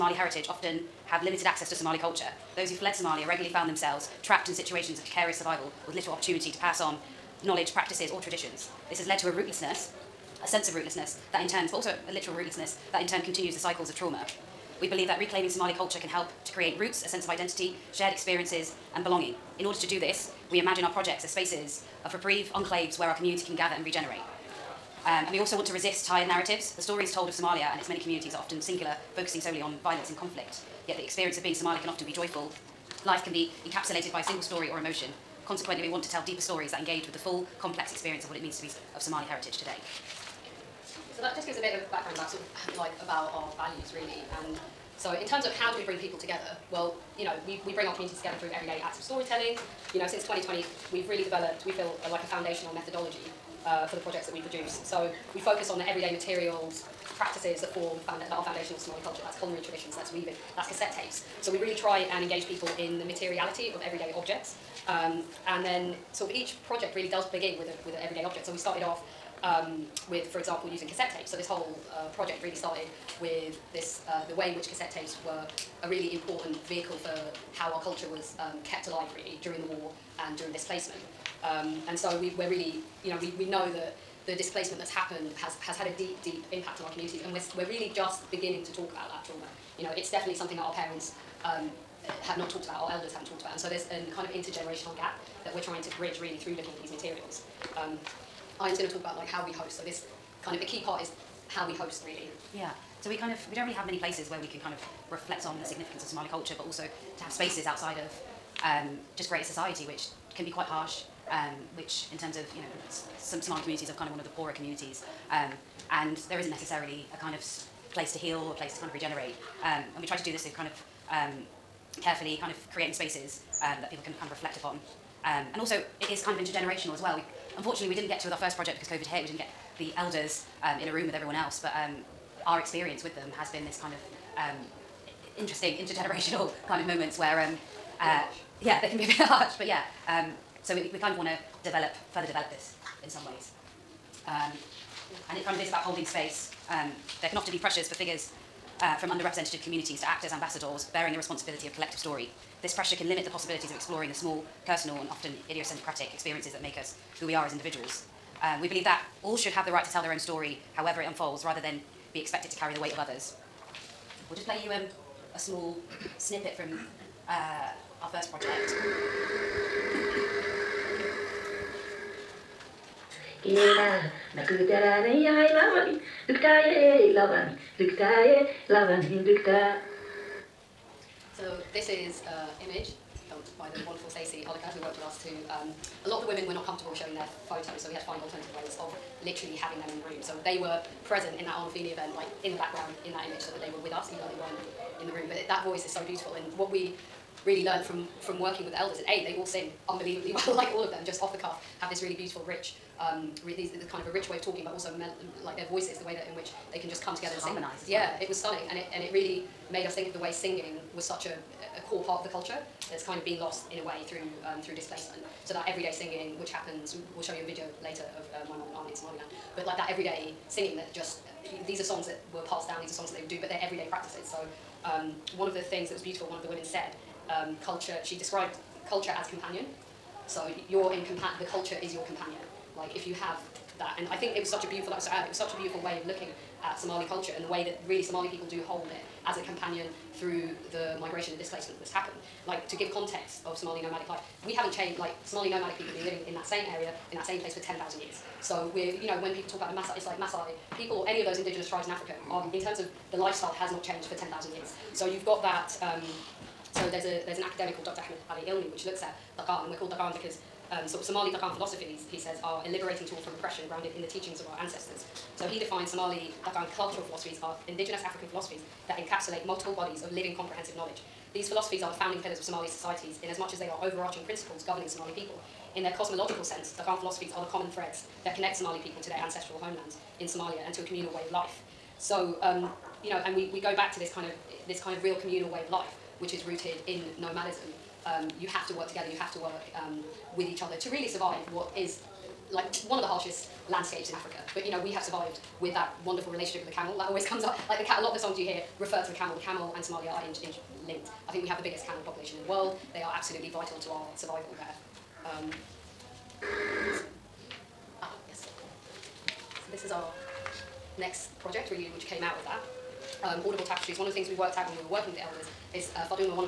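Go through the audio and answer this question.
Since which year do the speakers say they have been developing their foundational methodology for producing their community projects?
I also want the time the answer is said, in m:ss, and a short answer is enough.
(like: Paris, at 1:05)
2020, at 0:50.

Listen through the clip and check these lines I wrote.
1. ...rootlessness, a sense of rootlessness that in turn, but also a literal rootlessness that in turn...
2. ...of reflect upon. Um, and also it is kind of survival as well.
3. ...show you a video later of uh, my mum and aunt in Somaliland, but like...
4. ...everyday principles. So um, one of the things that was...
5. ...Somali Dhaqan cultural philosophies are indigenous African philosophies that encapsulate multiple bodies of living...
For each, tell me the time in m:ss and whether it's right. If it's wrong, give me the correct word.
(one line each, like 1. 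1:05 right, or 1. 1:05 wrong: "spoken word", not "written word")
1. 0:09 right
2. 2:04 wrong: "intergenerational", not "survival"
3. 3:37 right
4. 3:43 wrong: "practices", not "principles"
5. 4:25 right.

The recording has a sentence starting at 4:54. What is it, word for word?
But you know, we have survived with that wonderful relationship with the camel.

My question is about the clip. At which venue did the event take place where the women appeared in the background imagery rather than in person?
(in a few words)
Arnolfini.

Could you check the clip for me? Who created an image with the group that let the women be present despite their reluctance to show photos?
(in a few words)
Stacey Oliker.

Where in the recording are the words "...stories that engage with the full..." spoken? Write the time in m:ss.
0:36.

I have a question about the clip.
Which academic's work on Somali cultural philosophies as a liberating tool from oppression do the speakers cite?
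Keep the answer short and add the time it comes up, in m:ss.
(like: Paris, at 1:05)
Dr. Ahmed Ali Ilmi, at 4:17.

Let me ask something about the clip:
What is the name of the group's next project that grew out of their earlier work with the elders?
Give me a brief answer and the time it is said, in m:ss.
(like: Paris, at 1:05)
Audible Tapestries, at 5:13.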